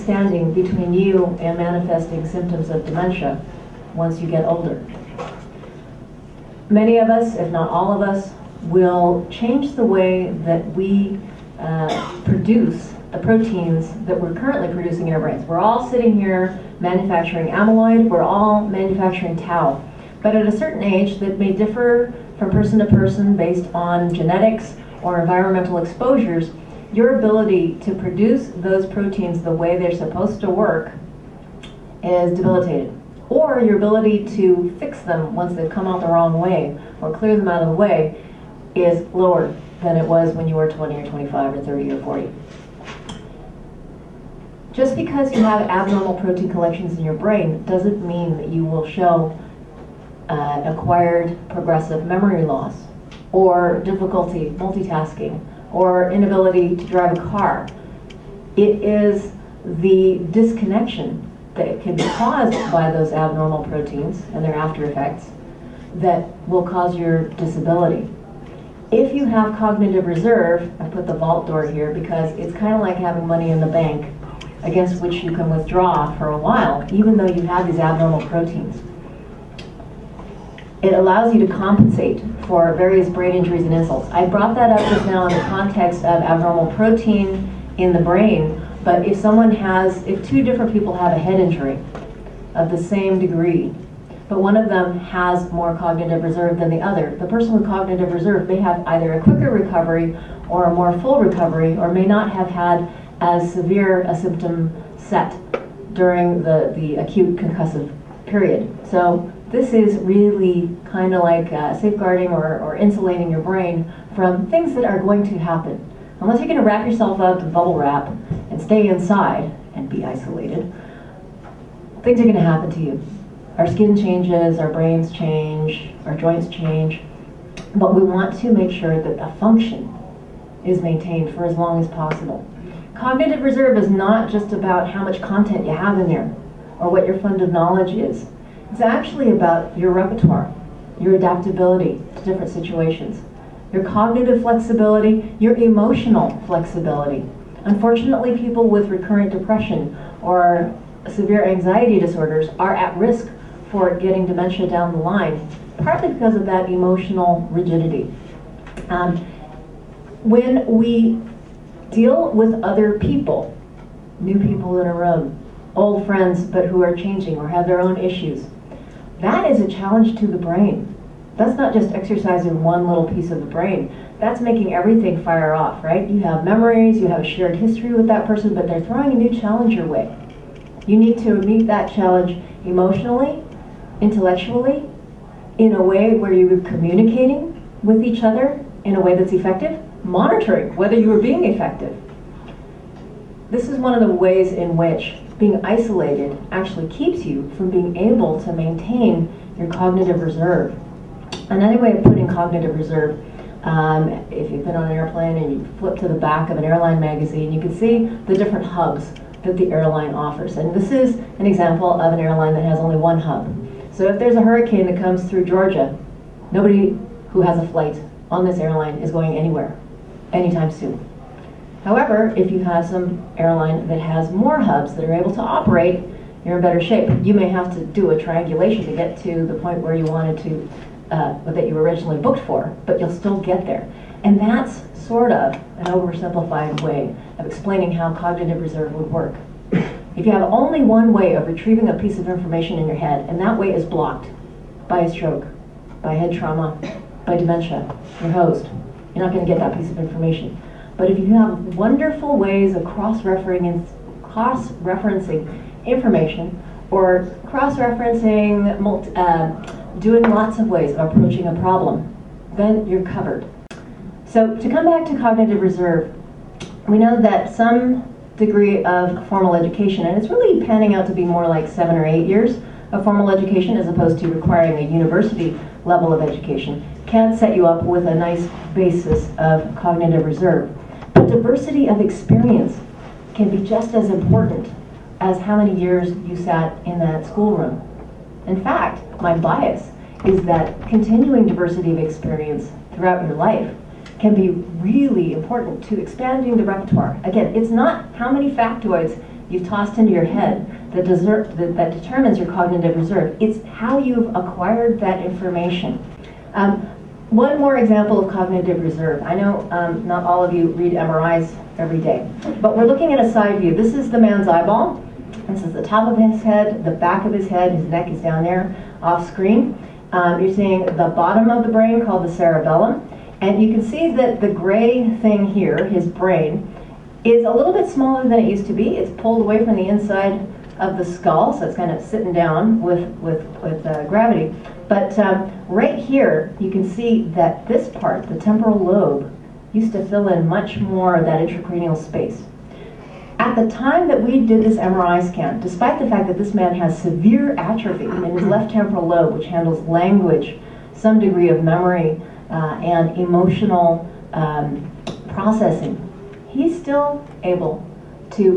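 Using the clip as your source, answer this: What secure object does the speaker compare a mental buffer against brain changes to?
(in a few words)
vault door.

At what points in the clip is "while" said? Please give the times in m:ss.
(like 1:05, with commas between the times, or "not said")
1:16.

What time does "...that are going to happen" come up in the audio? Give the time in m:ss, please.
1:54.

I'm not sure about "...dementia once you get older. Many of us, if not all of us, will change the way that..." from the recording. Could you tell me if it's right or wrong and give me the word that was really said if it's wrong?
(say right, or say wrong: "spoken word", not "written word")
right.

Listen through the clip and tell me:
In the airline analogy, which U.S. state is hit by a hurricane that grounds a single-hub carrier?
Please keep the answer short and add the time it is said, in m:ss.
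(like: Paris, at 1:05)
Georgia, at 3:35.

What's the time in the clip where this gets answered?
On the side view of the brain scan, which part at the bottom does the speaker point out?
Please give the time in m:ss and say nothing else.
5:22.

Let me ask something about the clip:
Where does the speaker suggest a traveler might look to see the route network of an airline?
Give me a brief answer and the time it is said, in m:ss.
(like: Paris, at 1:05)
airline magazine, at 3:26.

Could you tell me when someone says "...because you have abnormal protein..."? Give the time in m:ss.
0:44.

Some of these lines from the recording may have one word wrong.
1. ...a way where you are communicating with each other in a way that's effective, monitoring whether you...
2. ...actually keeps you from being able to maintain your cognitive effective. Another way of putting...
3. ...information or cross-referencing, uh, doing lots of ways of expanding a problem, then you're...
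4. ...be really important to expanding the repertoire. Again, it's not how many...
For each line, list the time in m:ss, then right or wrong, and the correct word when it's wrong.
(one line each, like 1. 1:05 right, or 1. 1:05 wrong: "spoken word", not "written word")
1. 3:05 right
2. 3:16 wrong: "reserve", not "effective"
3. 4:15 wrong: "approaching", not "expanding"
4. 4:54 right.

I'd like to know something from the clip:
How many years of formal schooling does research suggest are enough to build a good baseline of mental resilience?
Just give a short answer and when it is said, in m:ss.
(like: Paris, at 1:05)
7 or 8, at 4:31.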